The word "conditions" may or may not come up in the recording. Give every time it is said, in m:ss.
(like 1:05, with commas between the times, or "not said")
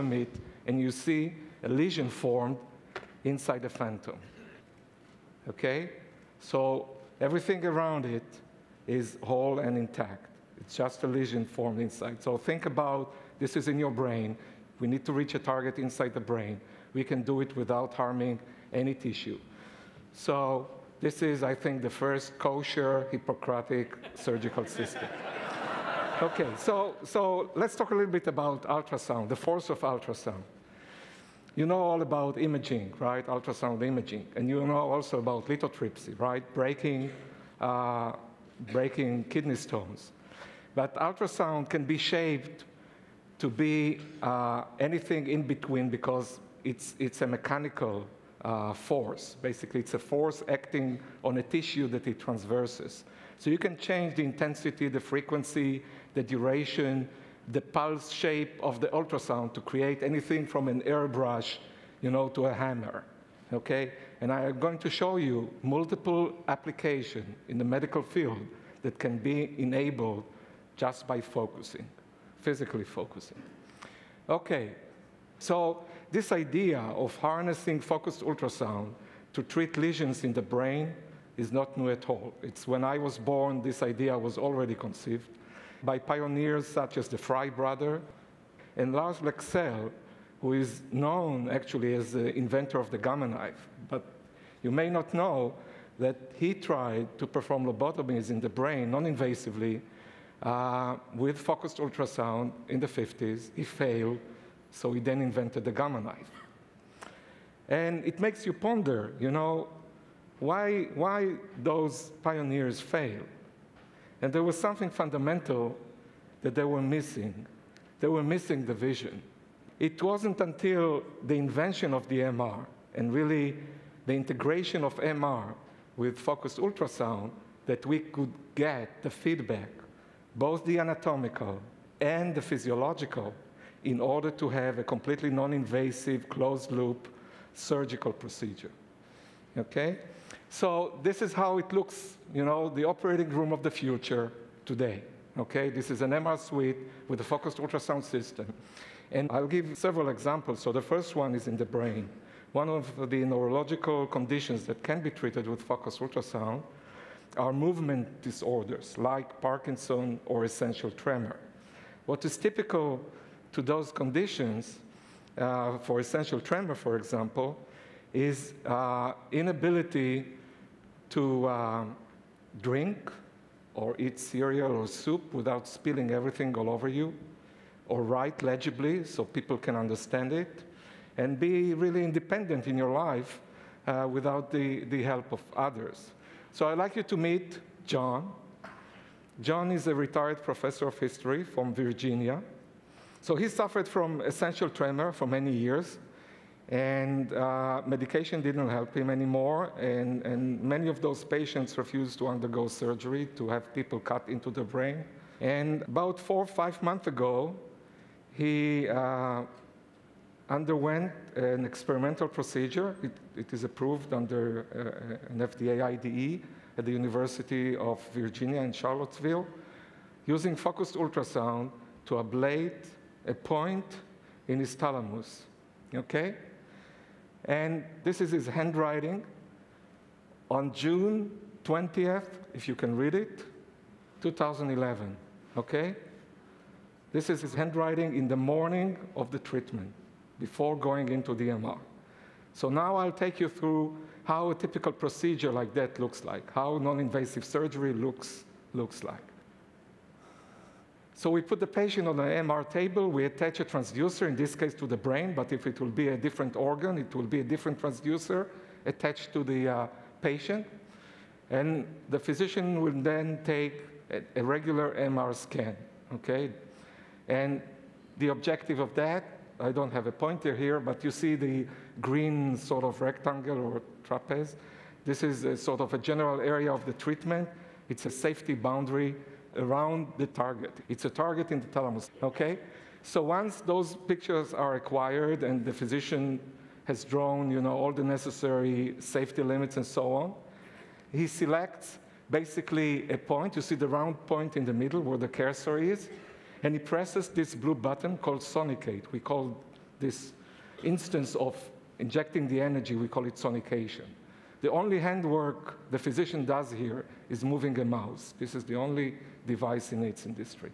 2:34, 2:43.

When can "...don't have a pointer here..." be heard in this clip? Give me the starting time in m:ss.
4:29.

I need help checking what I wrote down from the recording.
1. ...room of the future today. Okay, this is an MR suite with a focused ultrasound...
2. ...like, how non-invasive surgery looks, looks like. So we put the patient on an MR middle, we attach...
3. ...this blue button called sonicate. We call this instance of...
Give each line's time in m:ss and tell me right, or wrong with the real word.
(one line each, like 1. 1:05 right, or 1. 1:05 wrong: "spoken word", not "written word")
1. 2:23 right
2. 4:06 wrong: "table", not "middle"
3. 4:57 right.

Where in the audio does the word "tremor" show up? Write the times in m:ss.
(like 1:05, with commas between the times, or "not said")
2:40, 2:46, 3:14.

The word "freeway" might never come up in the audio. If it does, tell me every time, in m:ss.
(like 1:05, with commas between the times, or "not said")
not said.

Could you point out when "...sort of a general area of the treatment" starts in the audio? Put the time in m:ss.
4:35.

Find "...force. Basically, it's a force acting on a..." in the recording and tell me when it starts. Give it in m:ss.
0:48.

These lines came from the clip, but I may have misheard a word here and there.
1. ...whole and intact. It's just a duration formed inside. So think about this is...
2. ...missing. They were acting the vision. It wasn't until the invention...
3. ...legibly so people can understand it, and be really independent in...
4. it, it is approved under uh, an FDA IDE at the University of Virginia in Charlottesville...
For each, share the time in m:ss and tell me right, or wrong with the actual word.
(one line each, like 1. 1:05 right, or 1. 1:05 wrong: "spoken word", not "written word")
1. 0:09 wrong: "lesion", not "duration"
2. 1:56 wrong: "missing", not "acting"
3. 2:58 right
4. 3:33 right.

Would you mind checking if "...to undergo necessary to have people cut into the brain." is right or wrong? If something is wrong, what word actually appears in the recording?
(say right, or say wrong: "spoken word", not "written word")
wrong: "surgery", not "necessary".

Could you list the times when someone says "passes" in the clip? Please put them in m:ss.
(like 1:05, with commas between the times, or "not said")
not said.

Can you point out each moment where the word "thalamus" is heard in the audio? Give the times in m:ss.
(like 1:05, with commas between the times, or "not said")
3:44, 4:41.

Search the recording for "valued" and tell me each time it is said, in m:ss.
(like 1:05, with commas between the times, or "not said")
not said.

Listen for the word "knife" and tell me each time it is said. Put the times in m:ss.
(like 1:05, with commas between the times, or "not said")
1:33, 1:46.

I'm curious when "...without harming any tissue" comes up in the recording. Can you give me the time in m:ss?
0:17.